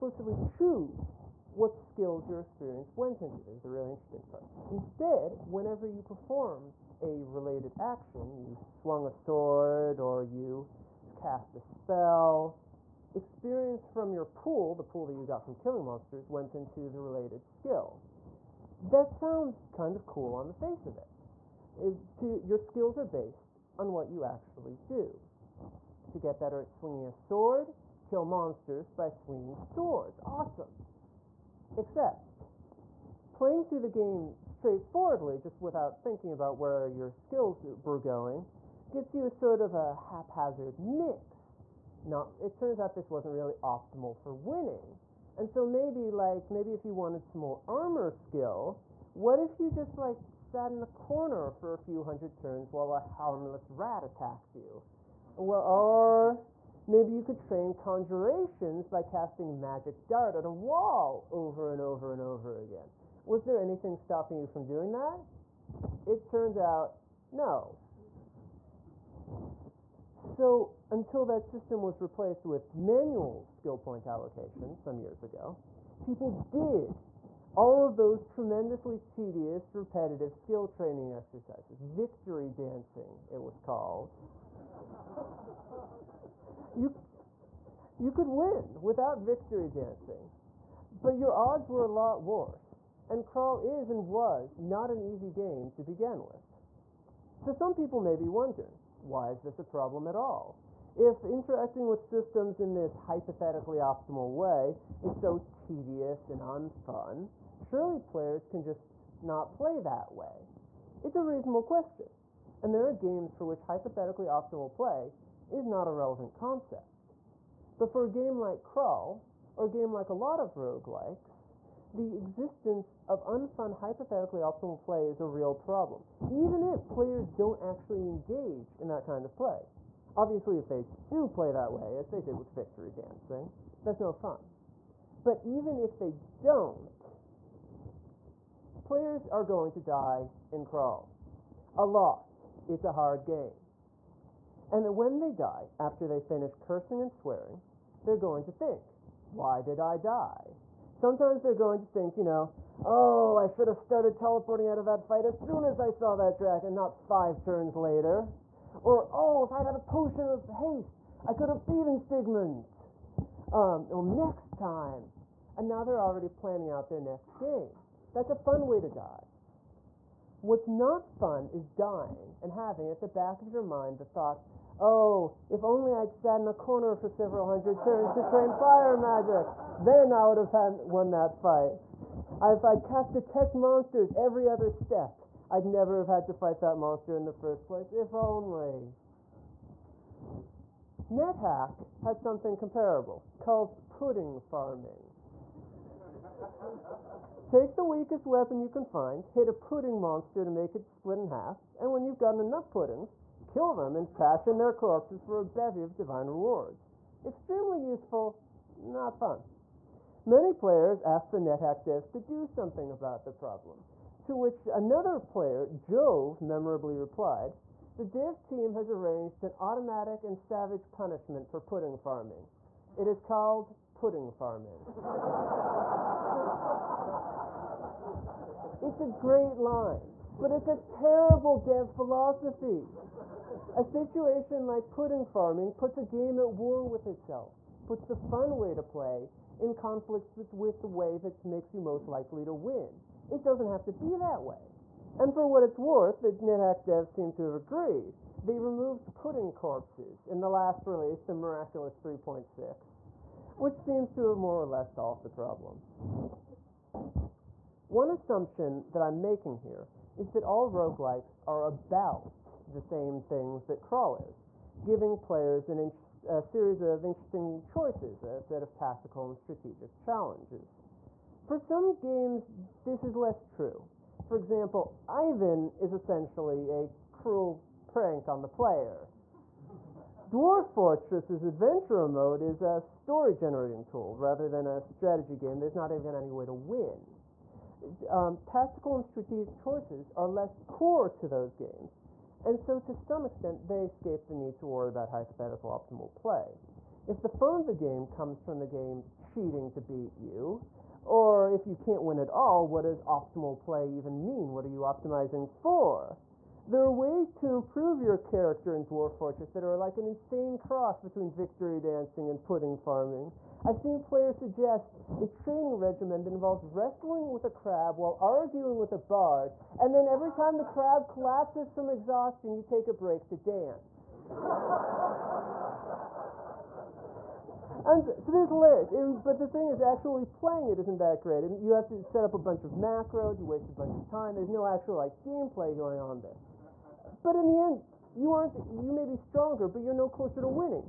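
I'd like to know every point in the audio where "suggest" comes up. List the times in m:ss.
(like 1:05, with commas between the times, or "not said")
5:14.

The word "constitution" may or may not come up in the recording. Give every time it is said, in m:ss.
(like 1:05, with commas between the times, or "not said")
not said.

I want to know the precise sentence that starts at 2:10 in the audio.
Obviously, if they do play that way, as they did with Victory Dancing, that's no fun.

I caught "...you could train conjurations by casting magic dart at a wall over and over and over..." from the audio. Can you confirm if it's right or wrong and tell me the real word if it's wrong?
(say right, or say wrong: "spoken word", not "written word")
right.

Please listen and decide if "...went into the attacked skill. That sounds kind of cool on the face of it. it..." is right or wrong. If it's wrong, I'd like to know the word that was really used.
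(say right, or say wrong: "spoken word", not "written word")
wrong: "related", not "attacked".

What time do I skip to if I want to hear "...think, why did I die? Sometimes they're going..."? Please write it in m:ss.
2:28.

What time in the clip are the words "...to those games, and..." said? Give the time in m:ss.
4:51.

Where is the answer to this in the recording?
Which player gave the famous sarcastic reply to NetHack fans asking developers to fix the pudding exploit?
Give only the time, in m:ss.
3:35.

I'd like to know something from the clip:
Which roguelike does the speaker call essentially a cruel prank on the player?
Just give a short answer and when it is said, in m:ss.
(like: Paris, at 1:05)
Ivan, at 4:35.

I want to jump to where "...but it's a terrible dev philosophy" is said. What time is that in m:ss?
3:50.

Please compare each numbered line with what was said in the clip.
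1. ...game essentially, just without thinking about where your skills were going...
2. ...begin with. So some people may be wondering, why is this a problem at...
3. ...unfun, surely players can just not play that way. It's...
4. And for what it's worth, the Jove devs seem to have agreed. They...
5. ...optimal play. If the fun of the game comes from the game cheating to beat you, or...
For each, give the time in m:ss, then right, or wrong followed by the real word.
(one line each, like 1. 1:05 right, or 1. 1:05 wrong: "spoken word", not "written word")
1. 0:33 wrong: "straightforwardly", not "essentially"
2. 1:35 right
3. 1:46 right
4. 4:05 wrong: "NetHack", not "Jove"
5. 4:55 right.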